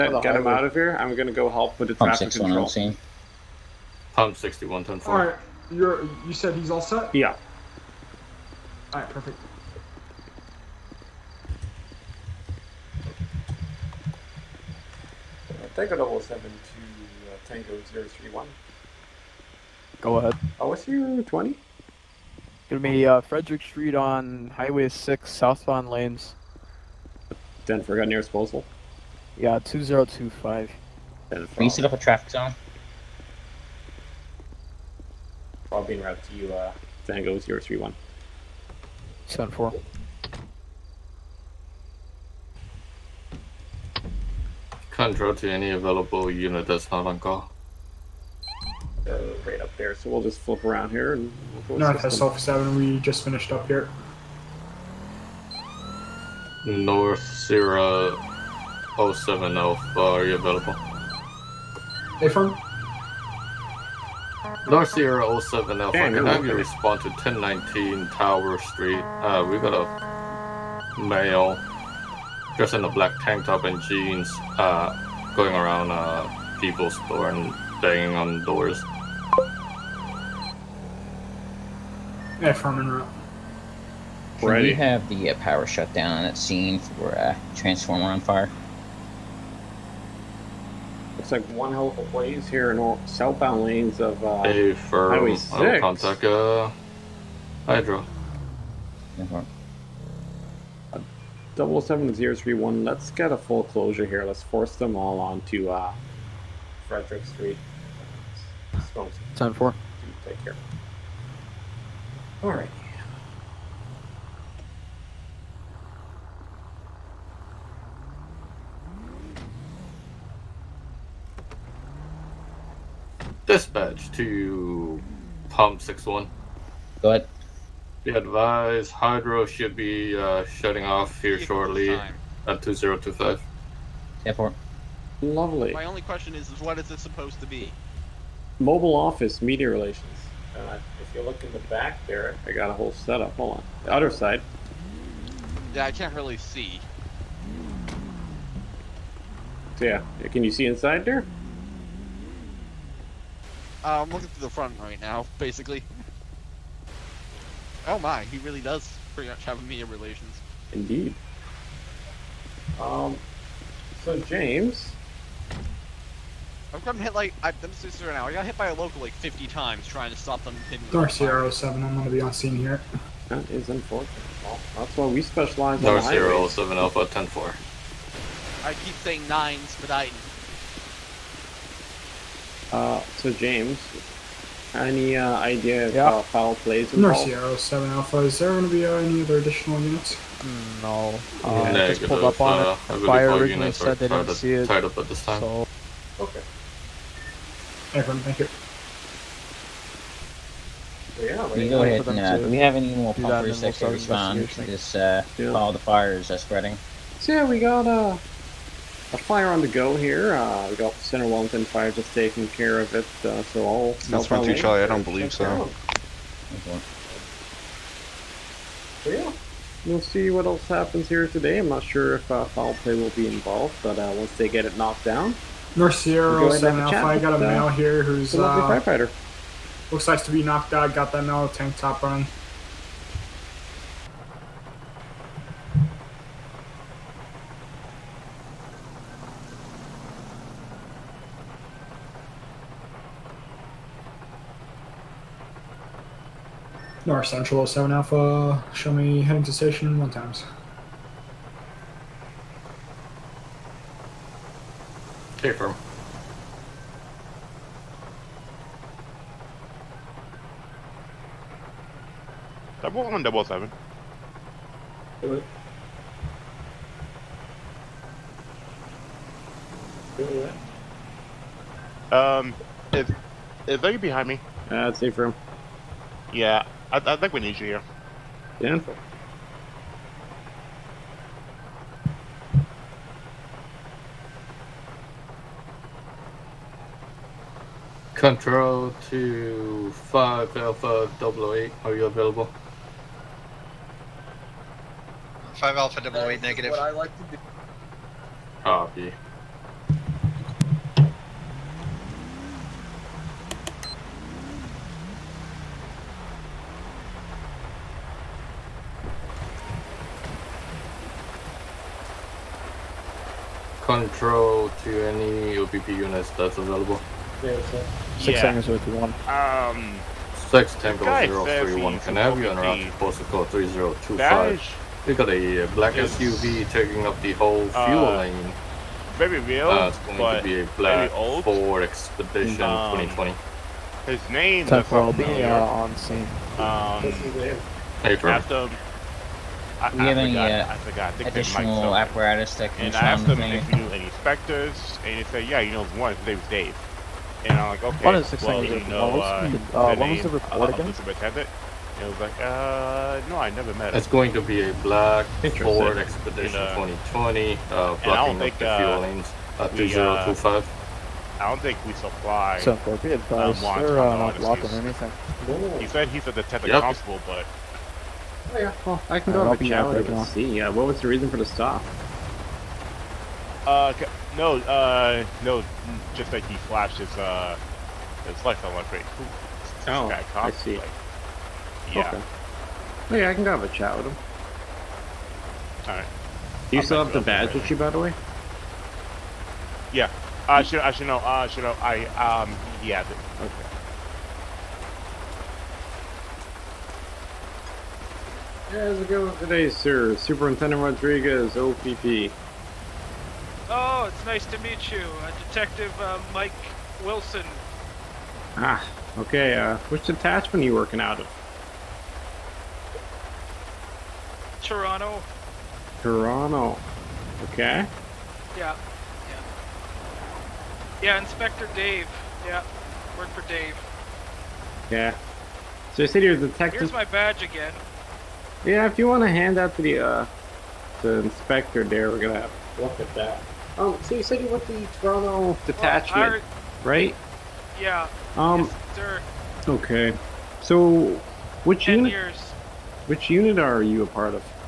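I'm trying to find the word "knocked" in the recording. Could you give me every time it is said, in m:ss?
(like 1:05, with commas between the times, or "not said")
3:44, 3:50.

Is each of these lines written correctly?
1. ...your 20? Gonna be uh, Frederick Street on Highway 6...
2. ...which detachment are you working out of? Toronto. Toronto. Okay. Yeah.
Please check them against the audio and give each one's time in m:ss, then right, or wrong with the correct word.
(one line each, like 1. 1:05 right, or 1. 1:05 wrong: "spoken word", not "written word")
1. 0:20 right
2. 6:49 right.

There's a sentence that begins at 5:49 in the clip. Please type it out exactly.
the, uh, what was the uh, report uh, again?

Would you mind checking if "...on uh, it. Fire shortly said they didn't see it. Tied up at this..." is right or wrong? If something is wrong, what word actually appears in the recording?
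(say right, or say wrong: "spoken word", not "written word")
wrong: "originally", not "shortly".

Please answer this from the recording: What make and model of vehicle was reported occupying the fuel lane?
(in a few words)
Ford Expedition.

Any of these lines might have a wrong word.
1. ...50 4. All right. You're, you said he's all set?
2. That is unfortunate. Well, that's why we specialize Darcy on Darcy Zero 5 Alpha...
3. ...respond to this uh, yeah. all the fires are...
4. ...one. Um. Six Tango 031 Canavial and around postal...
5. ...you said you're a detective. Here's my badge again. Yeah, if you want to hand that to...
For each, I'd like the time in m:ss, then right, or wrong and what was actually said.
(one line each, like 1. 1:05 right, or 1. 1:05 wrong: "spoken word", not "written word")
1. 0:04 wrong: "10", not "50"
2. 2:53 wrong: "7", not "5"
3. 3:23 right
4. 5:19 right
5. 7:06 right.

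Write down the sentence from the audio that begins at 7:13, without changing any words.
Um, so you said you went to the Toronto detachment, right?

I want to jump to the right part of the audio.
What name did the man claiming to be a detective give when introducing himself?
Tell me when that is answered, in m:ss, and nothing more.
6:45.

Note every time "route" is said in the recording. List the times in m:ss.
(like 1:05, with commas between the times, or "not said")
0:36, 1:22.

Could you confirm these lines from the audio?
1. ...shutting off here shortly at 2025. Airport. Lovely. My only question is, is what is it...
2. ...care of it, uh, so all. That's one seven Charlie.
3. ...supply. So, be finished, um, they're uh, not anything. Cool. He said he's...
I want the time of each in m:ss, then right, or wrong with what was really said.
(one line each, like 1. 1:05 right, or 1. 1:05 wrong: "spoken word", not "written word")
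1. 2:10 right
2. 3:32 wrong: "two", not "seven"
3. 6:01 wrong: "advised", not "finished".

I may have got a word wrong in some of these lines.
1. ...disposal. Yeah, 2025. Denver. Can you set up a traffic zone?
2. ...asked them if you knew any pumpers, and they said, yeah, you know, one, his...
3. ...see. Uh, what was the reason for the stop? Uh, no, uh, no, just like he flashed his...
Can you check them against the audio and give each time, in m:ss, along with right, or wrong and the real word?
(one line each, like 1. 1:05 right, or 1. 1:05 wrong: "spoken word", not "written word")
1. 0:28 right
2. 5:42 wrong: "specters", not "pumpers"
3. 6:10 right.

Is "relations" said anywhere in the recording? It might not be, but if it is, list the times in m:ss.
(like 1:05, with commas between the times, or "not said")
2:19, 2:39.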